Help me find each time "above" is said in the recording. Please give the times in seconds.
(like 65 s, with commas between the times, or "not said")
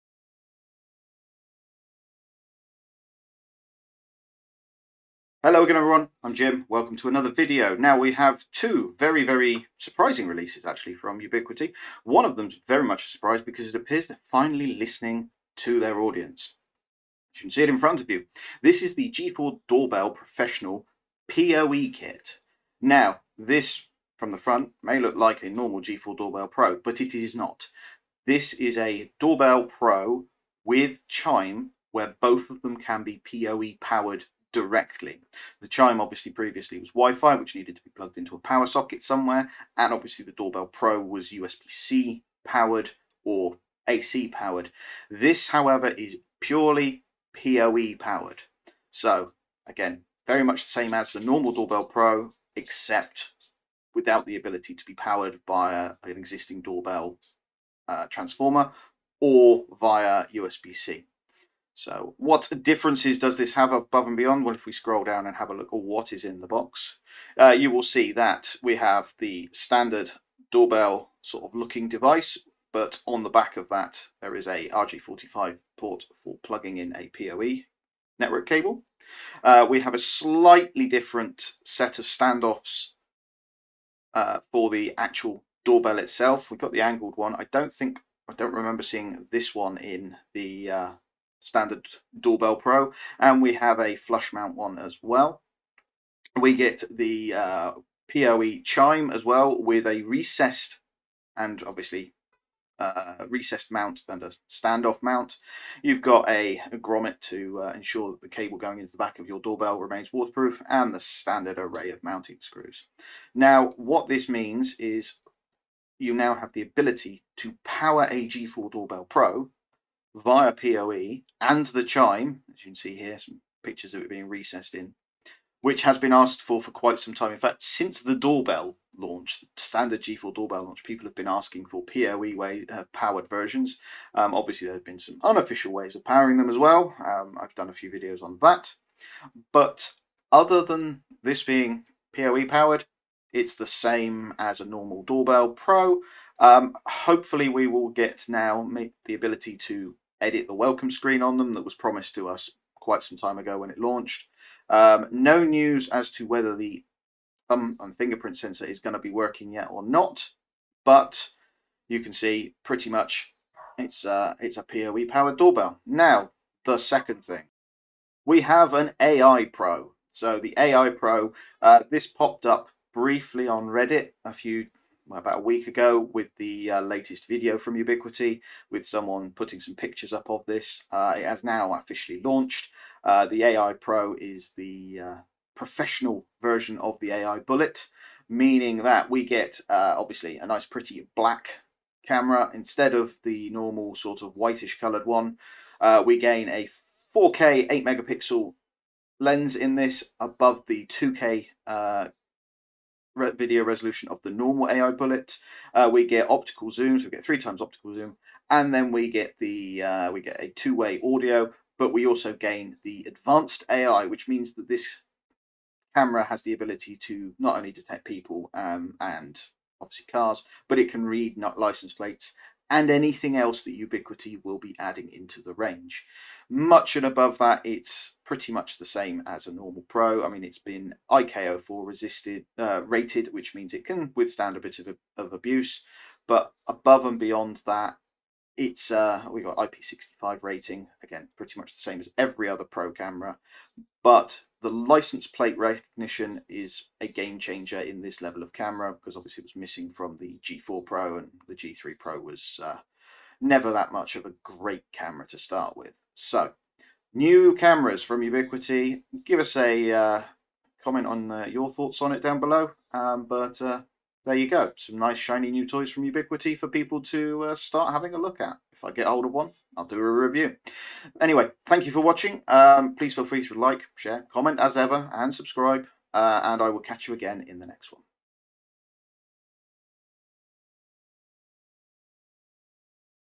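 63 s, 200 s, 227 s, 236 s.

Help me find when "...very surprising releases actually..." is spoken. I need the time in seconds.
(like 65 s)
9 s.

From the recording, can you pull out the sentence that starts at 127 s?
In fact, since the doorbell launch, the standard G4 doorbell launch, people have been asking for PoE way, uh, powered versions.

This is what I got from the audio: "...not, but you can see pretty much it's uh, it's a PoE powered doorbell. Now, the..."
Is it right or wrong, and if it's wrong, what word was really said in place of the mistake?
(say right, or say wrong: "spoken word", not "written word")
right.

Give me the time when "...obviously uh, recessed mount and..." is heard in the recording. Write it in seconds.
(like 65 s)
101 s.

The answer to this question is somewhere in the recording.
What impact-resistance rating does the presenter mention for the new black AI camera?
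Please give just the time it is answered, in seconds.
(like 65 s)
231 s.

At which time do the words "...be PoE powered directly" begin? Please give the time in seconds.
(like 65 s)
33 s.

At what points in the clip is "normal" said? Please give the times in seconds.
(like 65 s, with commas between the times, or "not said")
25 s, 51 s, 144 s, 193 s, 204 s, 229 s.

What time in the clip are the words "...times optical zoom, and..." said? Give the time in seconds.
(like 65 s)
207 s.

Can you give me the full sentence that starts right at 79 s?
Uh, we have a slightly different set of standoffs uh, for the actual doorbell itself.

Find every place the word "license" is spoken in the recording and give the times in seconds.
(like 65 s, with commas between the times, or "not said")
221 s, 244 s.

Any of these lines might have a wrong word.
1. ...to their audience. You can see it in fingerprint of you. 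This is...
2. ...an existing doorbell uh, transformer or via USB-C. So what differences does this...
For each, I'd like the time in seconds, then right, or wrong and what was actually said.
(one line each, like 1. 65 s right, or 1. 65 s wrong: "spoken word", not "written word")
1. 15 s wrong: "front", not "fingerprint"
2. 56 s right.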